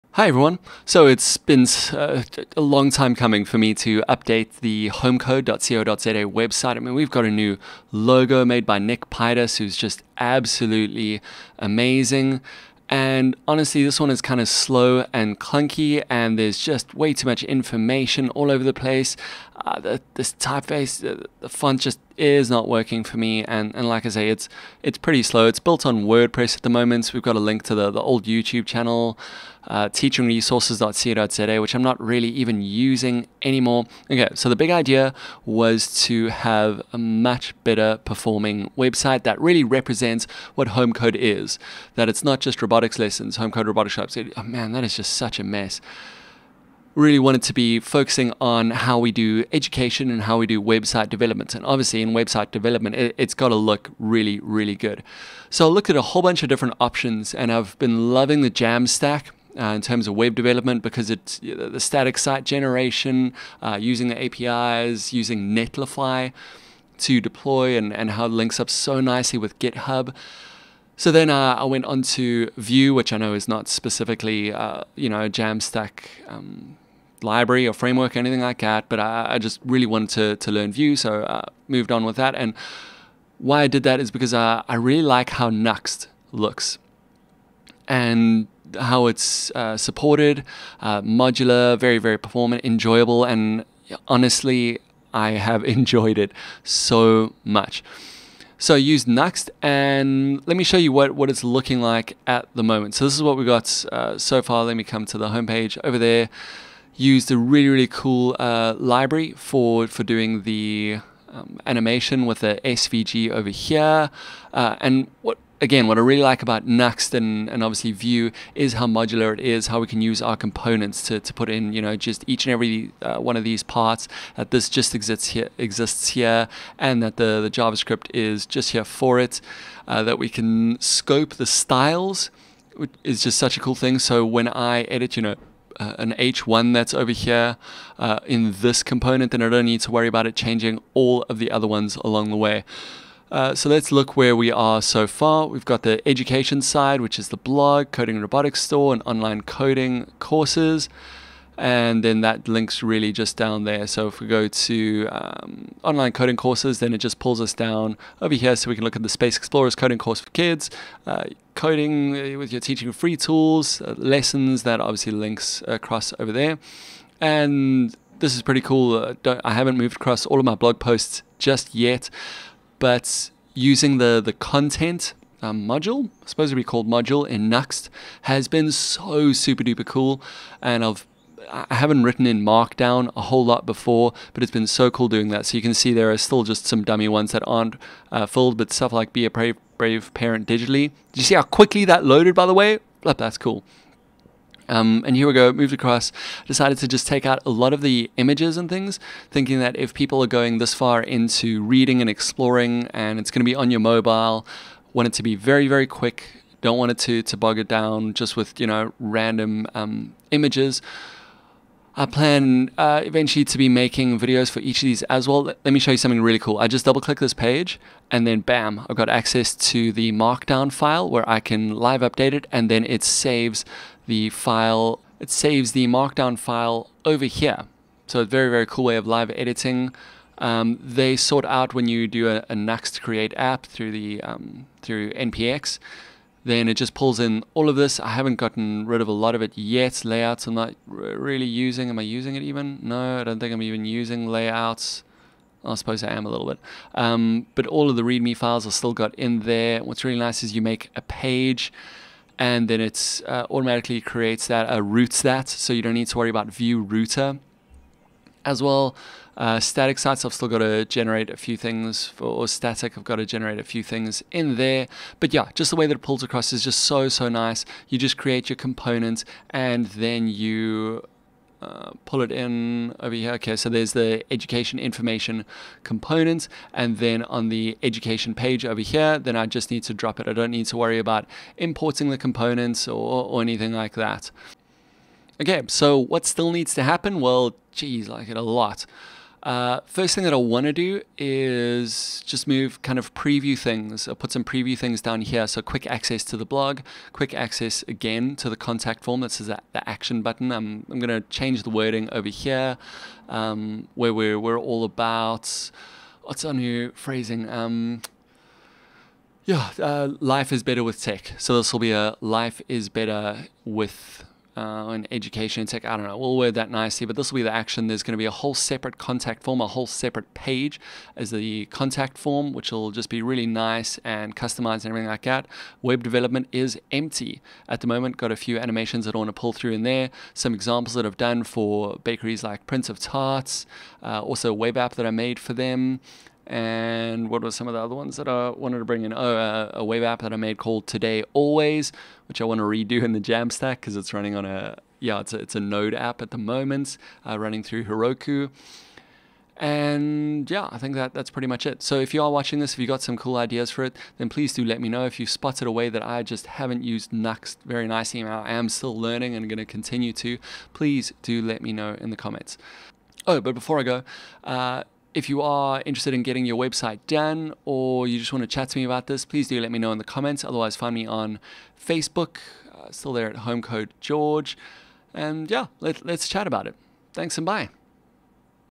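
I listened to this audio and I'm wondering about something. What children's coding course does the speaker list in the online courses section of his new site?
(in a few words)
Space Explorers.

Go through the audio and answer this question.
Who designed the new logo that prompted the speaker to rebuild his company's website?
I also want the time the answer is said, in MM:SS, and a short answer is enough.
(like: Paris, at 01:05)
Nick Pitus, at 00:08.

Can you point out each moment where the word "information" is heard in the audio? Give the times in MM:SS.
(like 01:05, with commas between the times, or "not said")
00:17, 04:34.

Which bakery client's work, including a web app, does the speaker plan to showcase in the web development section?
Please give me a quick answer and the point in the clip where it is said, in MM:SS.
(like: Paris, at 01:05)
Prince of Tarts, at 05:32.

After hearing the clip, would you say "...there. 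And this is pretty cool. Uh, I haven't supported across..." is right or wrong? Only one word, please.
wrong.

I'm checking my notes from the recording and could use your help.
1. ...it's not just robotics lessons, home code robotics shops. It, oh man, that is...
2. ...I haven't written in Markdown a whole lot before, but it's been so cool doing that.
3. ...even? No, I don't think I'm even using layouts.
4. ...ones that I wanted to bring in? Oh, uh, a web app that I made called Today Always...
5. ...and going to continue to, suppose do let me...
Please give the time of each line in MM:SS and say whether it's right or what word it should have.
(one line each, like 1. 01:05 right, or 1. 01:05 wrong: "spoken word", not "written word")
1. 00:42 right
2. 03:01 right
3. 04:02 right
4. 05:37 right
5. 05:59 wrong: "please", not "suppose".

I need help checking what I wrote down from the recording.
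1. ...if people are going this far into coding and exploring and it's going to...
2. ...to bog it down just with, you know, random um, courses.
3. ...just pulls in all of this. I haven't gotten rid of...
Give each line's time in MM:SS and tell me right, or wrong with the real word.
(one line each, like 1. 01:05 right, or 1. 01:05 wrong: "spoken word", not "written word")
1. 03:19 wrong: "reading", not "coding"
2. 03:27 wrong: "images", not "courses"
3. 03:56 right.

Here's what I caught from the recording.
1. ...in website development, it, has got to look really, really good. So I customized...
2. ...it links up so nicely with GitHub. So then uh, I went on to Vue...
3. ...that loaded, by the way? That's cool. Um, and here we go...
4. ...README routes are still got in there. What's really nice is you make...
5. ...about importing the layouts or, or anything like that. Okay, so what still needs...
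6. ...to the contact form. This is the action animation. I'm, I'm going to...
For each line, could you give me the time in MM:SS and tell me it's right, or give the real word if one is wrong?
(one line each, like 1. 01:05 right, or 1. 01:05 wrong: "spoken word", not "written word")
1. 00:52 wrong: "looked", not "customized"
2. 01:08 right
3. 03:11 right
4. 04:08 wrong: "files", not "routes"
5. 04:40 wrong: "components", not "layouts"
6. 04:58 wrong: "button", not "animation".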